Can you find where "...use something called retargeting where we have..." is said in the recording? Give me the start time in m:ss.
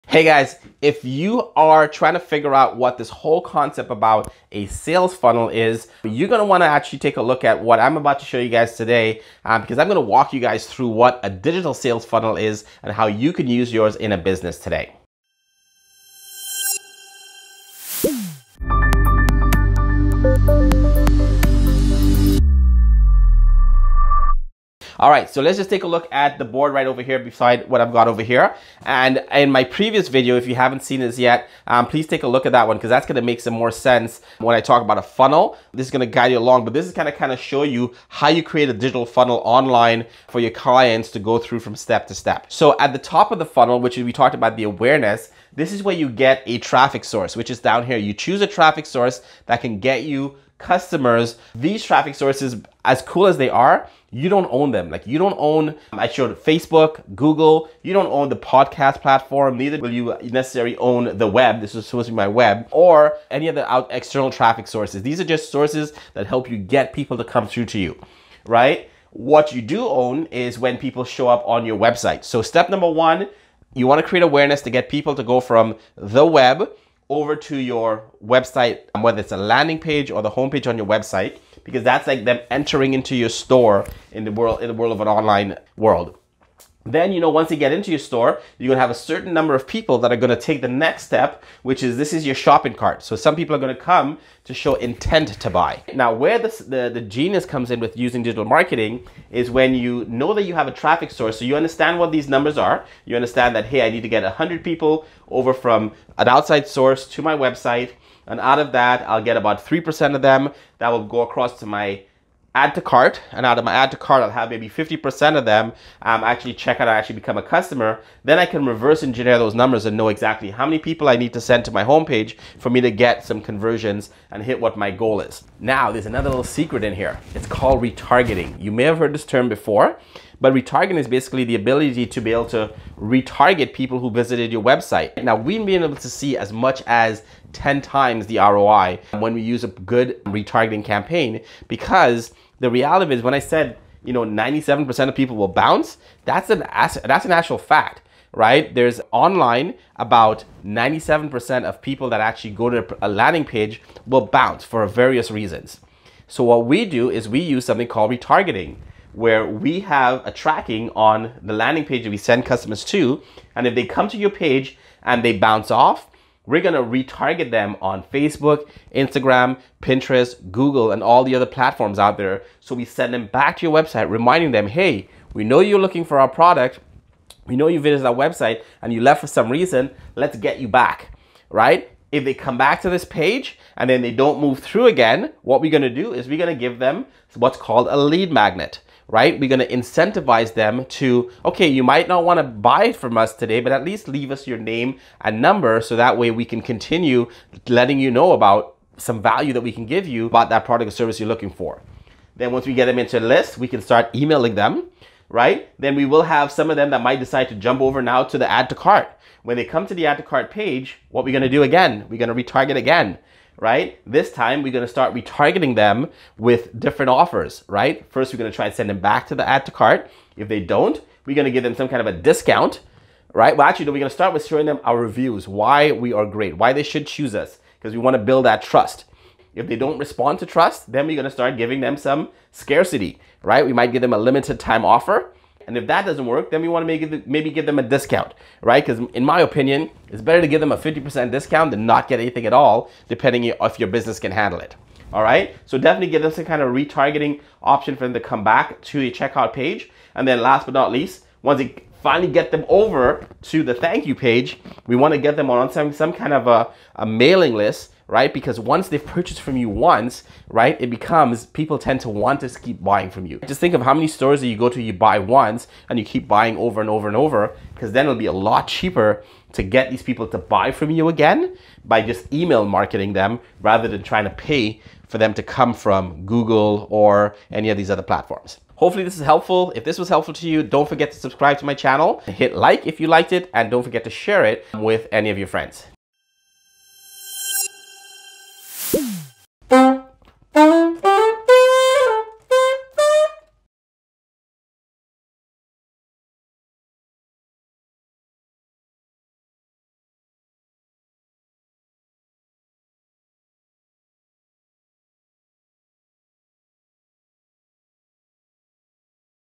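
2:37.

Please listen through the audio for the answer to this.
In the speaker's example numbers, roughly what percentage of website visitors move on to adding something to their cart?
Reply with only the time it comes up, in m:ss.
1:49.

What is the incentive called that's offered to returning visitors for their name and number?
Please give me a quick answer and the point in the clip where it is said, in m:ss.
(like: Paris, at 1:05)
lead magnet, at 3:07.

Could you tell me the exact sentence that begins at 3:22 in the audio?
Then once we get them into a list, we can start emailing them, right?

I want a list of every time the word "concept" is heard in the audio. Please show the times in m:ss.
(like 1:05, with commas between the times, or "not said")
0:03.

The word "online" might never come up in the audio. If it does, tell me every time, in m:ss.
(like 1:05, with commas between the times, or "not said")
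0:39, 1:25, 2:29.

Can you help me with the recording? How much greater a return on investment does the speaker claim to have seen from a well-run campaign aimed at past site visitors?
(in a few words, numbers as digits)
10 times.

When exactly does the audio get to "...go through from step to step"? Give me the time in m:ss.
0:41.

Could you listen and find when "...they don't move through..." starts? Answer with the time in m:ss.
3:04.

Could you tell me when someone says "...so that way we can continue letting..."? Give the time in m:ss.
3:15.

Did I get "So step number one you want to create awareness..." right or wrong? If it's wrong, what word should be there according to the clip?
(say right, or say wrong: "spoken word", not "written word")
right.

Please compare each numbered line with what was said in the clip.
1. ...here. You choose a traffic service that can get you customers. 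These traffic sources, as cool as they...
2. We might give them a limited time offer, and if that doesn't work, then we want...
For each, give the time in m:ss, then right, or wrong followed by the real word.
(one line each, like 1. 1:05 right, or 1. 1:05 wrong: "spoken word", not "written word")
1. 0:47 wrong: "source", not "service"
2. 3:53 right.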